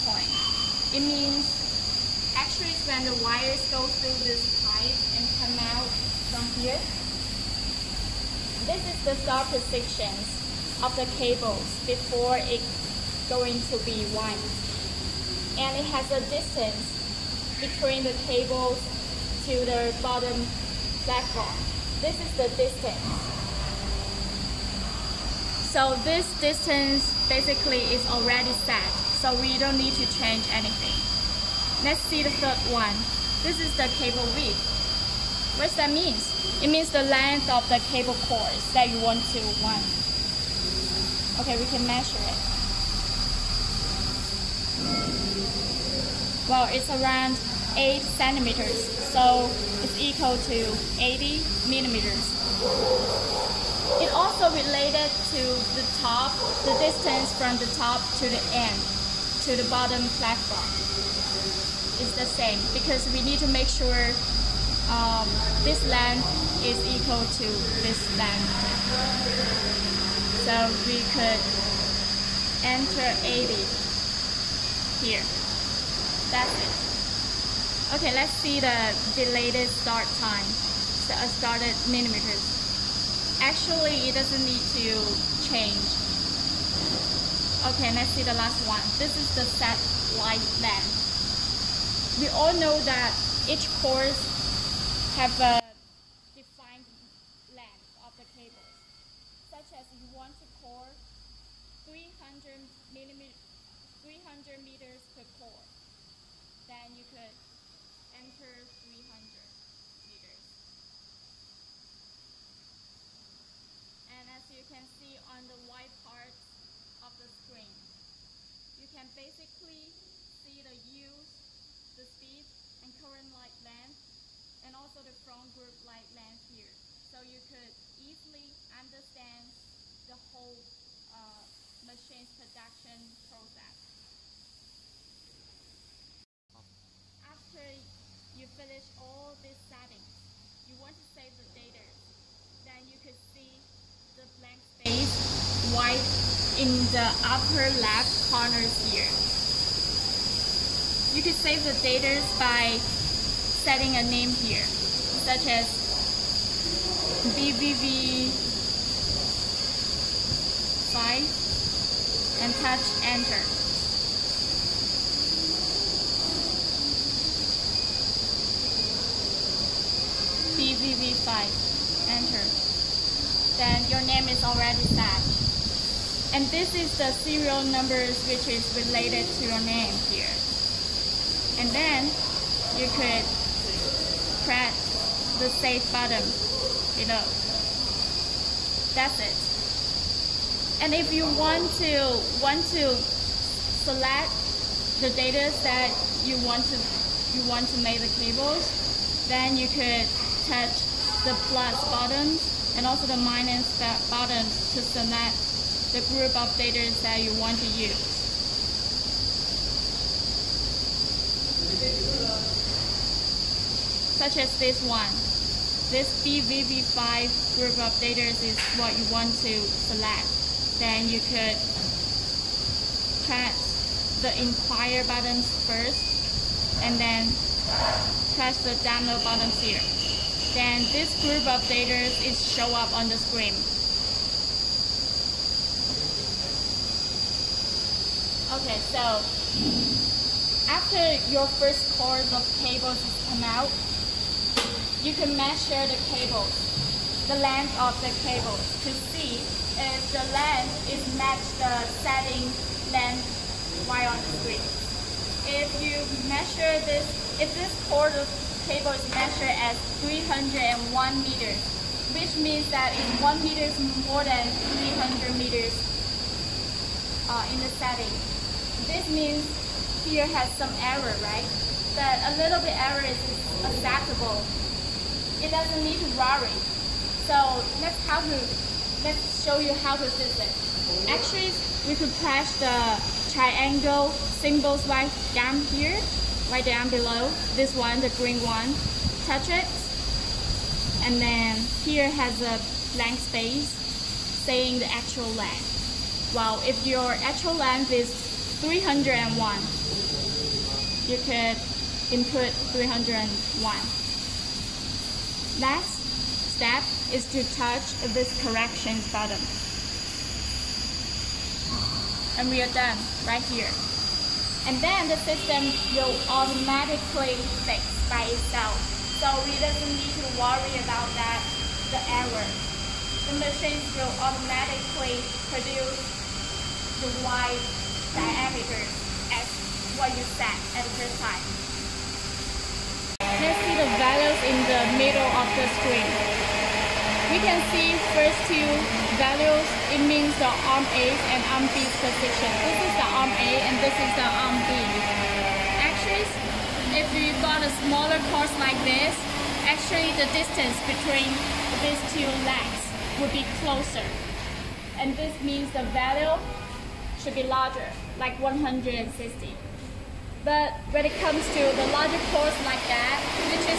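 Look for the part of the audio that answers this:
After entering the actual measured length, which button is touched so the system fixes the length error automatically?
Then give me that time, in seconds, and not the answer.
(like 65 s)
308 s.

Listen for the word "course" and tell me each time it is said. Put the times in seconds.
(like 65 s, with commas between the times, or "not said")
93 s, 241 s, 348 s.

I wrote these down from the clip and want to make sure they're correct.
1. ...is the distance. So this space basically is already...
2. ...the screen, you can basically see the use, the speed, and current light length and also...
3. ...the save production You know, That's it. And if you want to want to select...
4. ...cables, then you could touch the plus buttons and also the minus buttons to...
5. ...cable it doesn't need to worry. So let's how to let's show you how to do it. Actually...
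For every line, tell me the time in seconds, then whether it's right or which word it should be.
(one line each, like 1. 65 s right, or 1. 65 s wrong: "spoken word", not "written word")
1. 22 s wrong: "distance", not "space"
2. 117 s right
3. 185 s wrong: "button", not "production"
4. 198 s right
5. 273 s wrong: "acceptable", not "cable".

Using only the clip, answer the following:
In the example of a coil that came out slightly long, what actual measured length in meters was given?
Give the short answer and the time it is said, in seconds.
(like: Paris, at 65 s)
301 meters, at 260 s.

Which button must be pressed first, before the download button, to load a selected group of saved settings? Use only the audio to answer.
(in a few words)
inquire.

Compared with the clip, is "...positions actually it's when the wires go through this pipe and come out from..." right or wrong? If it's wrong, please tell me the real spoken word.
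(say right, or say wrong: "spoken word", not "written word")
wrong: "means", not "positions".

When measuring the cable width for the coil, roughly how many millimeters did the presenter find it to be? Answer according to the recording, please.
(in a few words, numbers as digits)
80 millimeters.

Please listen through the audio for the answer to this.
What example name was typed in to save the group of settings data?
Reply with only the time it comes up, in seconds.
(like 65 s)
157 s.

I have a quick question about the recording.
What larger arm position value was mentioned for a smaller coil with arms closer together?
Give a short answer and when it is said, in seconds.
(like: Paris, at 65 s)
160, at 358 s.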